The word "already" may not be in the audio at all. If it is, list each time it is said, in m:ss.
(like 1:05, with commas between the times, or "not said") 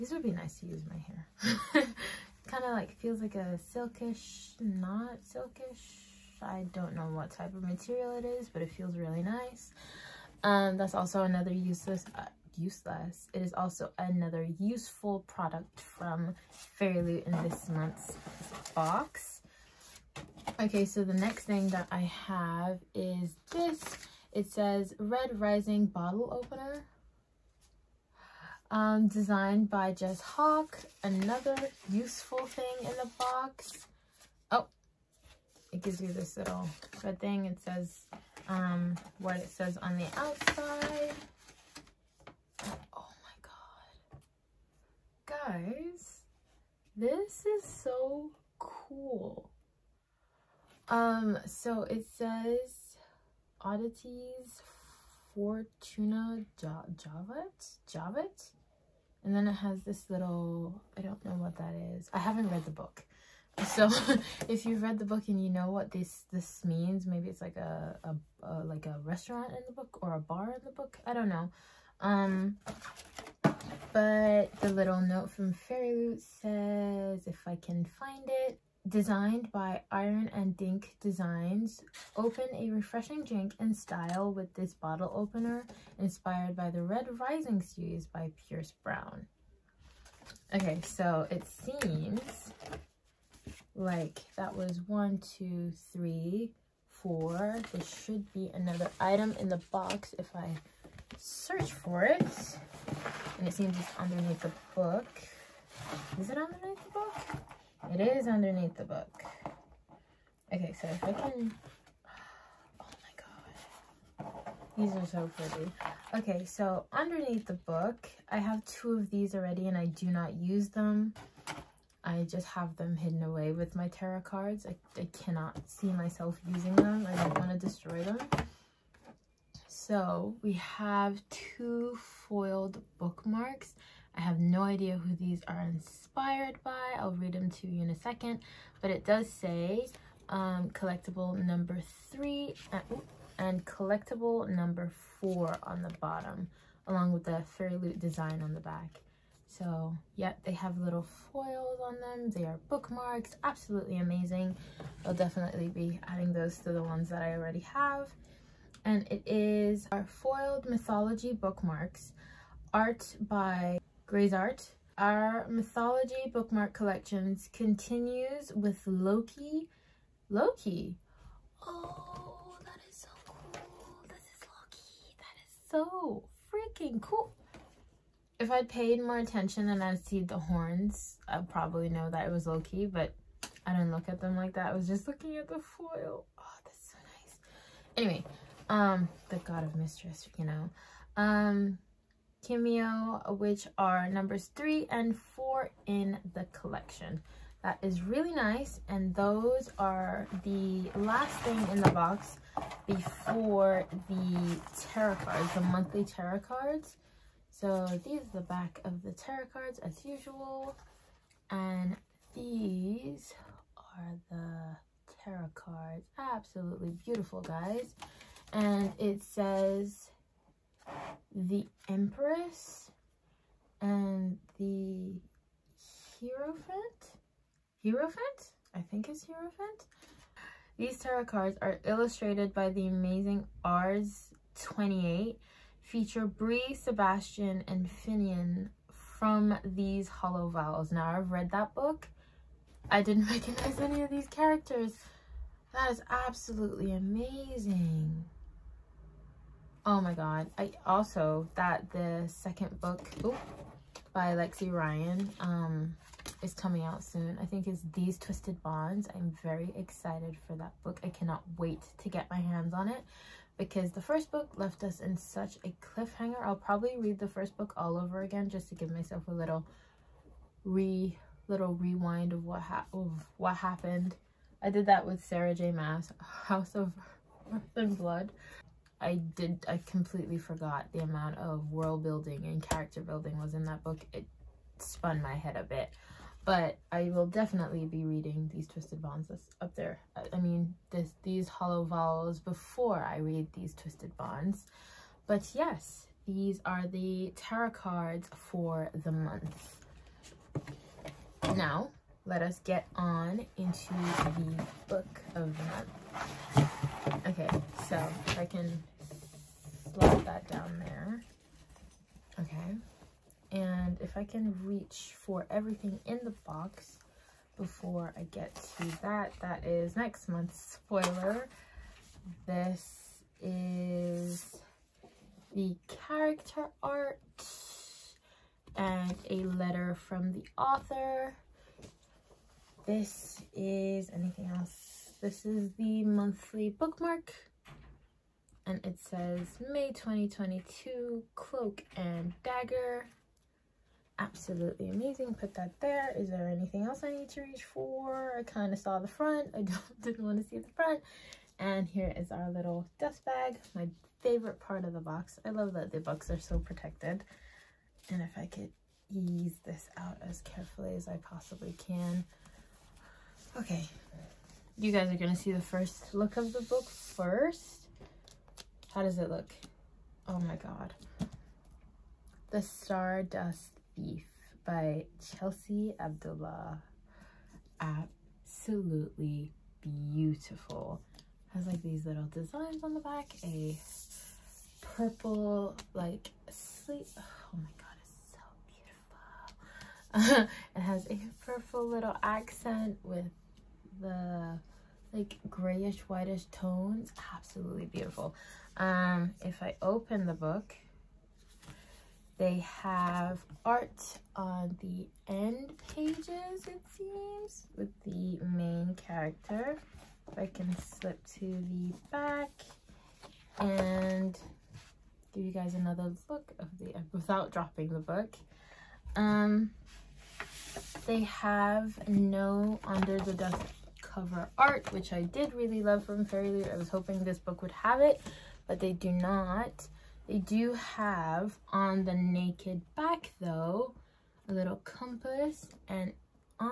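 1:59, 2:37.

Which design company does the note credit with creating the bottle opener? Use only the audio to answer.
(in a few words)
Iron and Dink Designs.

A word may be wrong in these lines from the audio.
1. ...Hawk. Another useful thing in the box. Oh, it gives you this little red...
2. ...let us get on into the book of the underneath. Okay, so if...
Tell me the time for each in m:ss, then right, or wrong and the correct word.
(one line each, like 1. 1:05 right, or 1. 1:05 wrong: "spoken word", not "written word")
1. 0:30 right
2. 5:02 wrong: "month", not "underneath".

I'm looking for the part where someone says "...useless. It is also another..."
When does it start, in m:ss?
0:12.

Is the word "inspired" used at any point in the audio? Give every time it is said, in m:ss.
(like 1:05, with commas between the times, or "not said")
1:25, 2:15.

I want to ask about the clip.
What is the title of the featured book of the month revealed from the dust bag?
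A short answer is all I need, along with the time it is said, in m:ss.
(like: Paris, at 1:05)
The Stardust Thief, at 6:12.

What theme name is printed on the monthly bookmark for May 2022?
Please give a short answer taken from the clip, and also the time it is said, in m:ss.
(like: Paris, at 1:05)
Cloak and Dagger, at 5:41.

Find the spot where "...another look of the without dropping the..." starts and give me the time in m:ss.
6:55.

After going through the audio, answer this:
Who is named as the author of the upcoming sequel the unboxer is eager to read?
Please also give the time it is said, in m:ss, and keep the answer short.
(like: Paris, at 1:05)
Lexi Ryan, at 4:14.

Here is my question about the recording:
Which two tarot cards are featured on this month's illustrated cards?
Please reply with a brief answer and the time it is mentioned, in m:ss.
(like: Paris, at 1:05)
The Empress and the Hierophant, at 3:41.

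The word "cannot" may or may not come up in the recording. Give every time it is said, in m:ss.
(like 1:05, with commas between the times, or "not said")
2:05, 4:21.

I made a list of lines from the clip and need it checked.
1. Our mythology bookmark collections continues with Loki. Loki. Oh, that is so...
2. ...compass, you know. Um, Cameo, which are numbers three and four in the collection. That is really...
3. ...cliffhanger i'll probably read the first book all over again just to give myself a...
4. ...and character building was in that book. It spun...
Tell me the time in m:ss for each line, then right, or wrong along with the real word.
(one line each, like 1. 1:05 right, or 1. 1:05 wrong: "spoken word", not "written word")
1. 2:44 right
2. 3:09 wrong: "mistress", not "compass"
3. 4:25 right
4. 4:42 right.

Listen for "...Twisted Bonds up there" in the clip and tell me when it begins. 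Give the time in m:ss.
4:48.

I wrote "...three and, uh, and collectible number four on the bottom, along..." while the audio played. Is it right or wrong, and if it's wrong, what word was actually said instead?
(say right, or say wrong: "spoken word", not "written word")
right.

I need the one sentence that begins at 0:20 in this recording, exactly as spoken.
Okay, so the next thing that I have is this it says Red Rising Bottle Opener.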